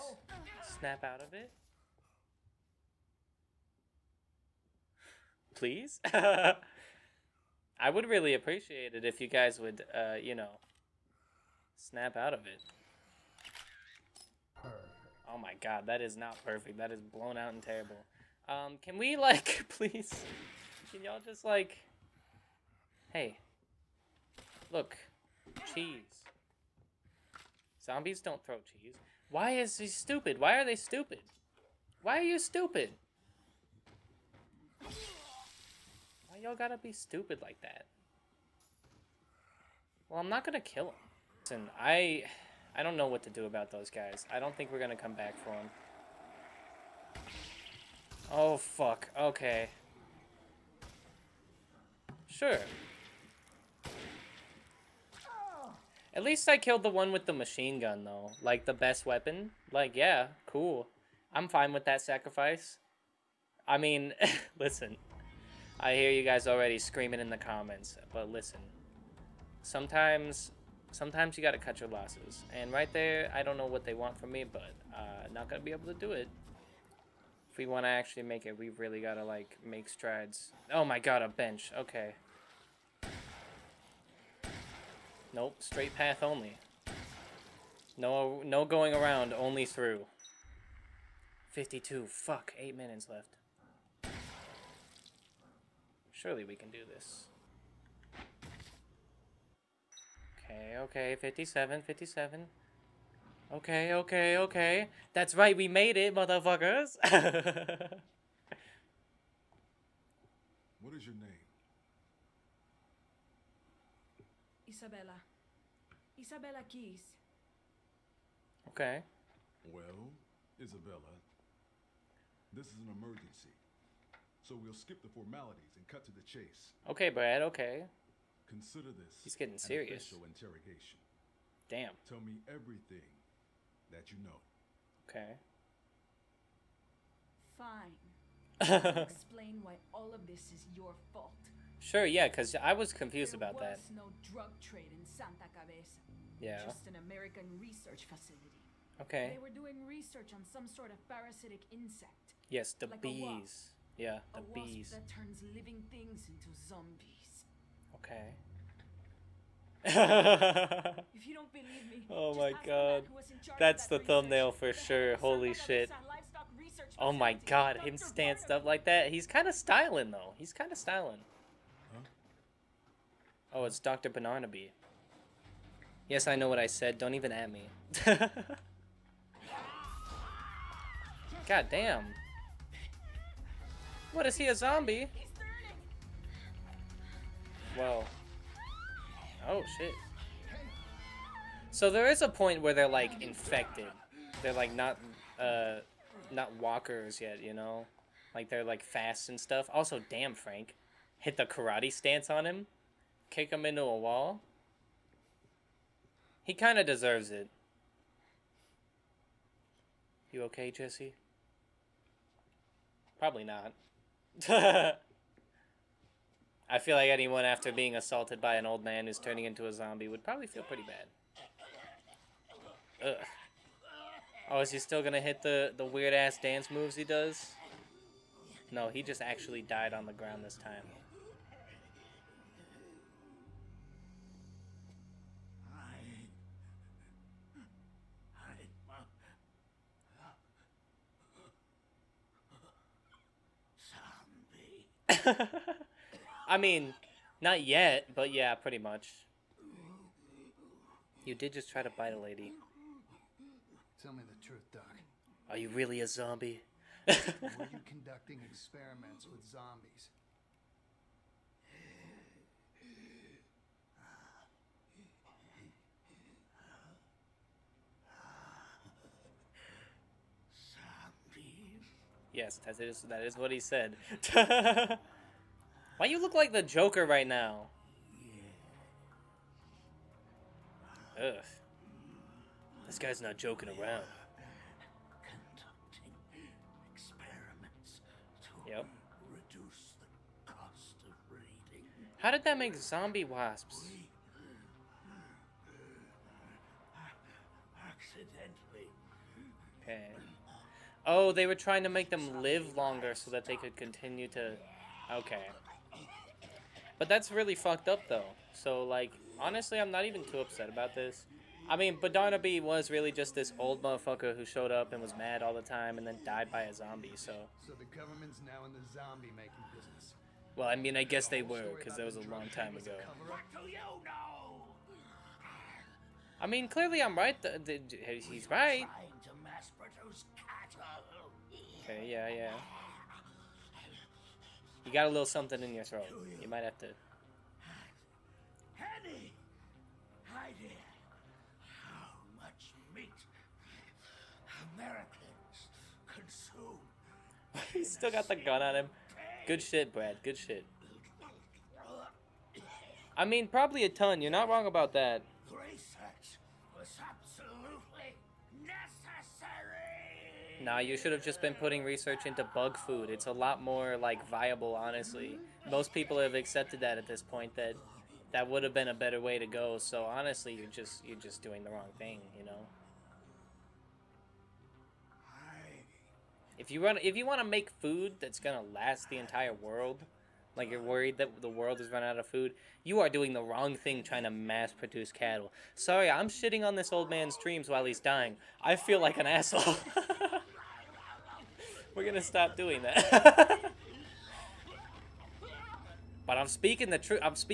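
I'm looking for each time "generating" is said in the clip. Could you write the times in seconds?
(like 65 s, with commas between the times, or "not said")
not said.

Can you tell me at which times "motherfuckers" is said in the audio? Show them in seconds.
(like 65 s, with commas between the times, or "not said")
106 s, 313 s.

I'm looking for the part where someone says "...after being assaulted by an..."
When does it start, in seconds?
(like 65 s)
217 s.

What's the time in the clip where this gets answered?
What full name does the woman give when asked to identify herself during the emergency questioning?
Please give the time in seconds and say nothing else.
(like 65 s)
116 s.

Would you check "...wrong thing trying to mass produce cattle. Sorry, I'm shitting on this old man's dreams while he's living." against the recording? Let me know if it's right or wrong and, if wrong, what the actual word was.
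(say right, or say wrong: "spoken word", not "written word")
wrong: "dying", not "living".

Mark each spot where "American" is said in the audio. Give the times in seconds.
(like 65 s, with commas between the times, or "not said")
147 s, 344 s.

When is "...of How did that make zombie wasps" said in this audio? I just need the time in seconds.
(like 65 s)
291 s.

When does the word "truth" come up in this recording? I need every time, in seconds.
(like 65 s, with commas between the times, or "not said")
254 s, 396 s.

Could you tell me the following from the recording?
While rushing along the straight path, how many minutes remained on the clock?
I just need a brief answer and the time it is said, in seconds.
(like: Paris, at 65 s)
8, at 92 s.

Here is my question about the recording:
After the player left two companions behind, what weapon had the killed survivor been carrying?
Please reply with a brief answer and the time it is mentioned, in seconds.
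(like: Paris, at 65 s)
machine gun, at 57 s.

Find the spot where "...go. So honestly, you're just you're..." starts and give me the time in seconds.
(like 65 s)
369 s.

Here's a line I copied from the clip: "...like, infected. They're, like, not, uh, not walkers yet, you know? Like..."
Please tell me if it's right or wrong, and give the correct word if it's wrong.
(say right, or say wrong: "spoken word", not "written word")
right.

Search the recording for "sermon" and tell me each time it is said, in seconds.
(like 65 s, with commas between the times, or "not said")
not said.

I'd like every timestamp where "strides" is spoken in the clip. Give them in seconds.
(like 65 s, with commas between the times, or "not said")
79 s.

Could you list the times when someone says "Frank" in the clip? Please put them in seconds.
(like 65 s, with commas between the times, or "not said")
200 s.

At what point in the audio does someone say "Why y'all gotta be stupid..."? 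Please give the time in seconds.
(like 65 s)
36 s.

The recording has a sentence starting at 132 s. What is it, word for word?
Tell me everything that you know.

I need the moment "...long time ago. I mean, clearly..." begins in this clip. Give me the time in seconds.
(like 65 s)
322 s.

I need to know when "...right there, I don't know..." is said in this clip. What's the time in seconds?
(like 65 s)
72 s.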